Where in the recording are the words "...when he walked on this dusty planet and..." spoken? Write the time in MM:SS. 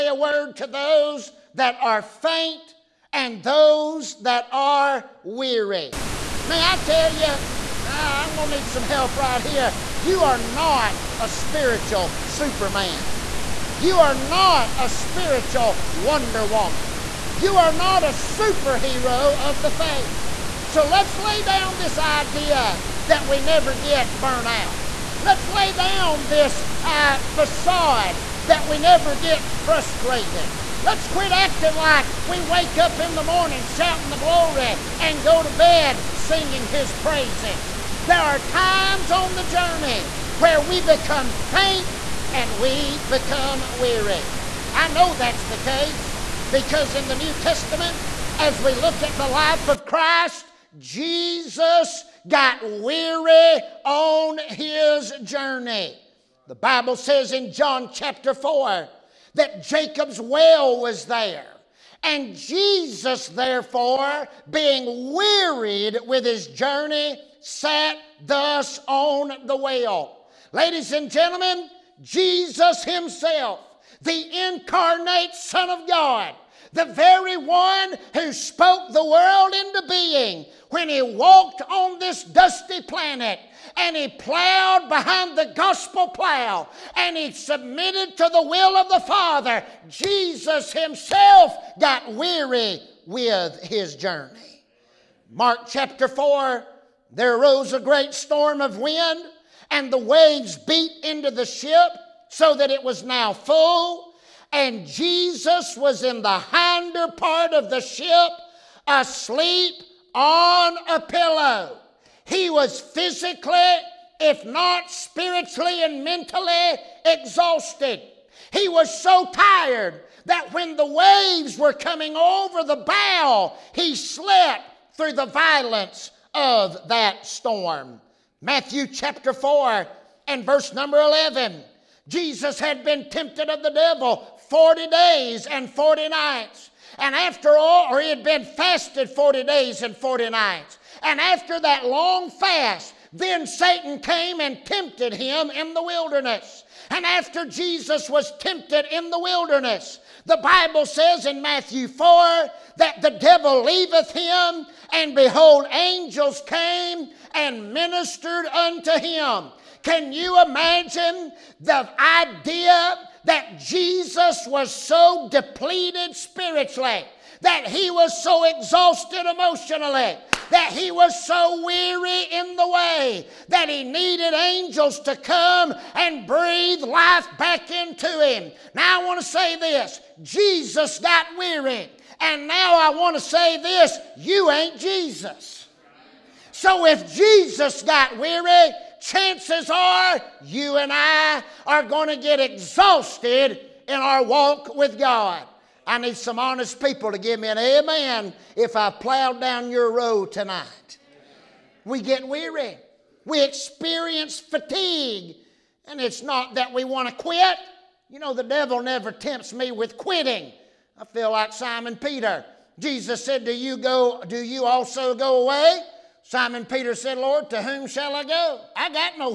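01:20.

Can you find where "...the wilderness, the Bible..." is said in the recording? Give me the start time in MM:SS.
02:29.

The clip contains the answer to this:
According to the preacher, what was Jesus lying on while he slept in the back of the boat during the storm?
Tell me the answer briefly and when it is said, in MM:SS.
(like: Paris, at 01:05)
A pillow, at 01:50.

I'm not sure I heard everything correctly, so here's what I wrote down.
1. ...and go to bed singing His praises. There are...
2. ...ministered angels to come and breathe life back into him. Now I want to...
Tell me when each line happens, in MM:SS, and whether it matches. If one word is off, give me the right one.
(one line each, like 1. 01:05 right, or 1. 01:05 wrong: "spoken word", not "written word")
1. 00:34 right
2. 02:53 wrong: "needed", not "ministered".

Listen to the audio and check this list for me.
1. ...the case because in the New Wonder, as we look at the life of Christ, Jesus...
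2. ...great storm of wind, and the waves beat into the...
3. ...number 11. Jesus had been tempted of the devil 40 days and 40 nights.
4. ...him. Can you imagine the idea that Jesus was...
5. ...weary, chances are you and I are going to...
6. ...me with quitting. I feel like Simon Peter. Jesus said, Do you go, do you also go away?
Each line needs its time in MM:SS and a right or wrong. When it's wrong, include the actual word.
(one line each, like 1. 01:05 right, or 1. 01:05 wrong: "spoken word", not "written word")
1. 00:45 wrong: "Testament", not "Wonder"
2. 01:37 right
3. 02:10 right
4. 02:38 right
5. 03:08 right
6. 03:29 right.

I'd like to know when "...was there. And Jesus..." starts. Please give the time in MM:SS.
01:00.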